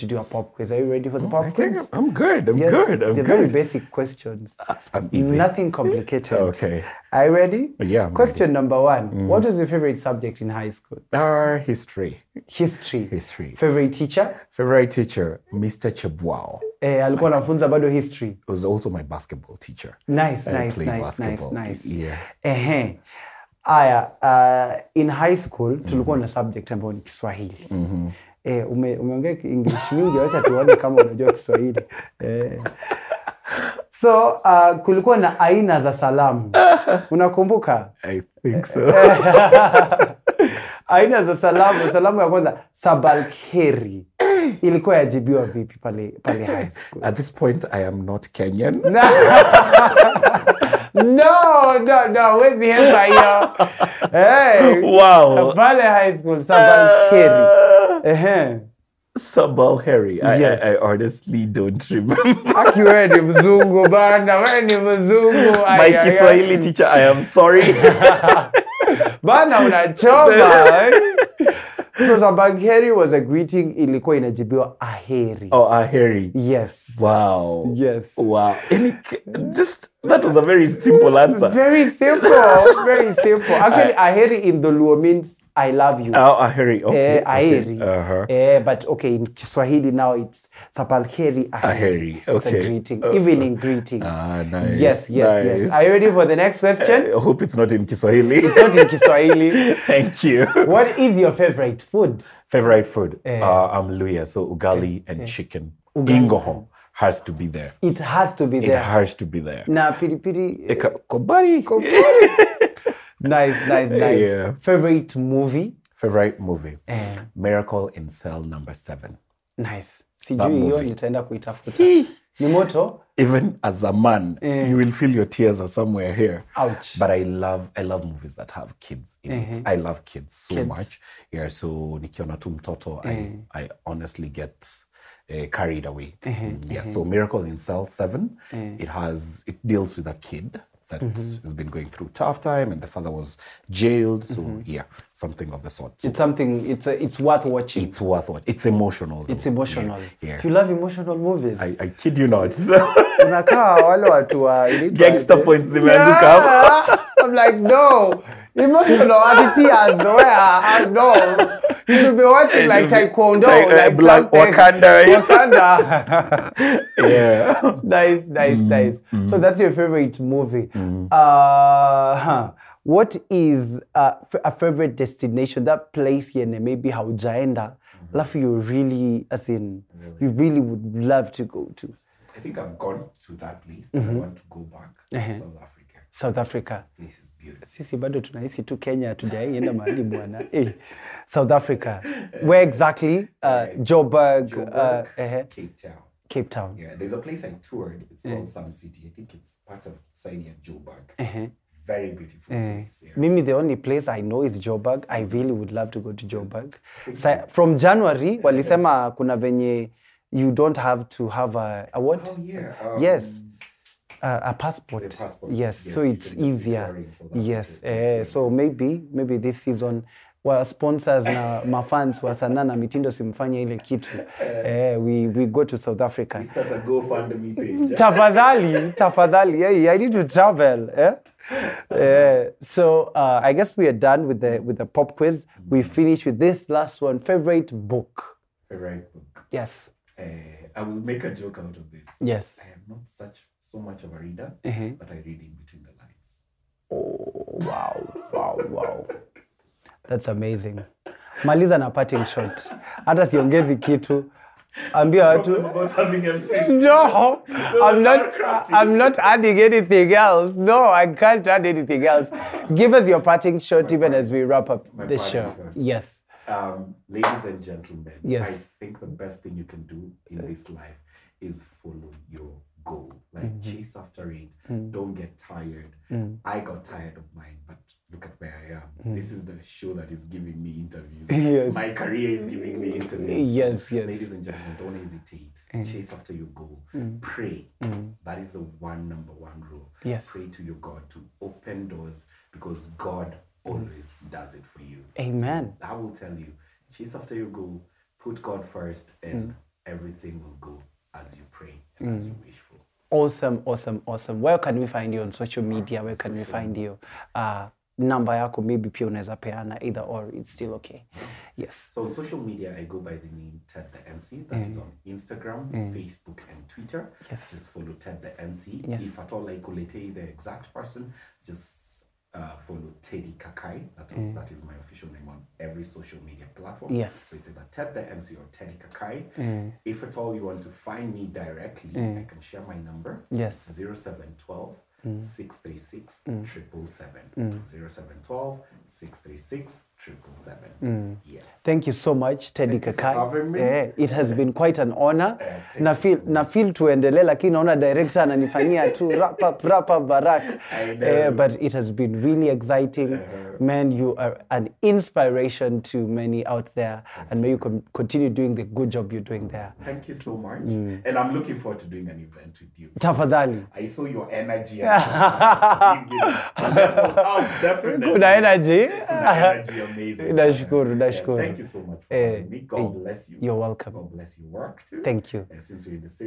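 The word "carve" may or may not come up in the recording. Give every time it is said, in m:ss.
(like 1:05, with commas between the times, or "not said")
not said.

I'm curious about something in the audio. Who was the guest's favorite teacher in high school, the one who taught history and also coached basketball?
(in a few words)
Mr. Chebwao.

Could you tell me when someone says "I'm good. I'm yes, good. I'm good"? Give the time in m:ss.
0:01.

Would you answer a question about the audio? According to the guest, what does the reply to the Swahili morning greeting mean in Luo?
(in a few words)
I love you.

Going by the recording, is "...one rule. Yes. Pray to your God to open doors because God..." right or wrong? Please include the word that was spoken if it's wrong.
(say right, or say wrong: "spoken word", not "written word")
right.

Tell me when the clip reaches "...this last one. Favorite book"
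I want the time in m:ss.
3:56.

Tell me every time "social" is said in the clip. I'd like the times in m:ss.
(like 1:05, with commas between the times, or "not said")
5:05, 5:12, 5:25.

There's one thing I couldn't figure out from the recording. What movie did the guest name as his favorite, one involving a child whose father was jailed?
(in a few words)
Miracle in Cell Number Seven.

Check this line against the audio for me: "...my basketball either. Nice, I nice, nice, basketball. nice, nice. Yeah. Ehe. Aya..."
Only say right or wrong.
wrong.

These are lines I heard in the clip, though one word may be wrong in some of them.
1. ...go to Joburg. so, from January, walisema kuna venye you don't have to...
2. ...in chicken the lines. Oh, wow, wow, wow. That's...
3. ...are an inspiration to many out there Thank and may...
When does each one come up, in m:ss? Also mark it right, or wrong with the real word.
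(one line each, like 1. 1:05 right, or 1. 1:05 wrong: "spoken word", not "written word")
1. 3:25 right
2. 4:05 wrong: "between", not "chicken"
3. 5:54 right.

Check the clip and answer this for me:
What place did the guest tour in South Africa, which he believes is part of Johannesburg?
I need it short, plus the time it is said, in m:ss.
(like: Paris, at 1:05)
Sun City, at 3:18.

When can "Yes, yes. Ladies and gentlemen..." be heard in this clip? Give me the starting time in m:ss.
4:43.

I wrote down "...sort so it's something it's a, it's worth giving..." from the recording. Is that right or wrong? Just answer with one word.
wrong.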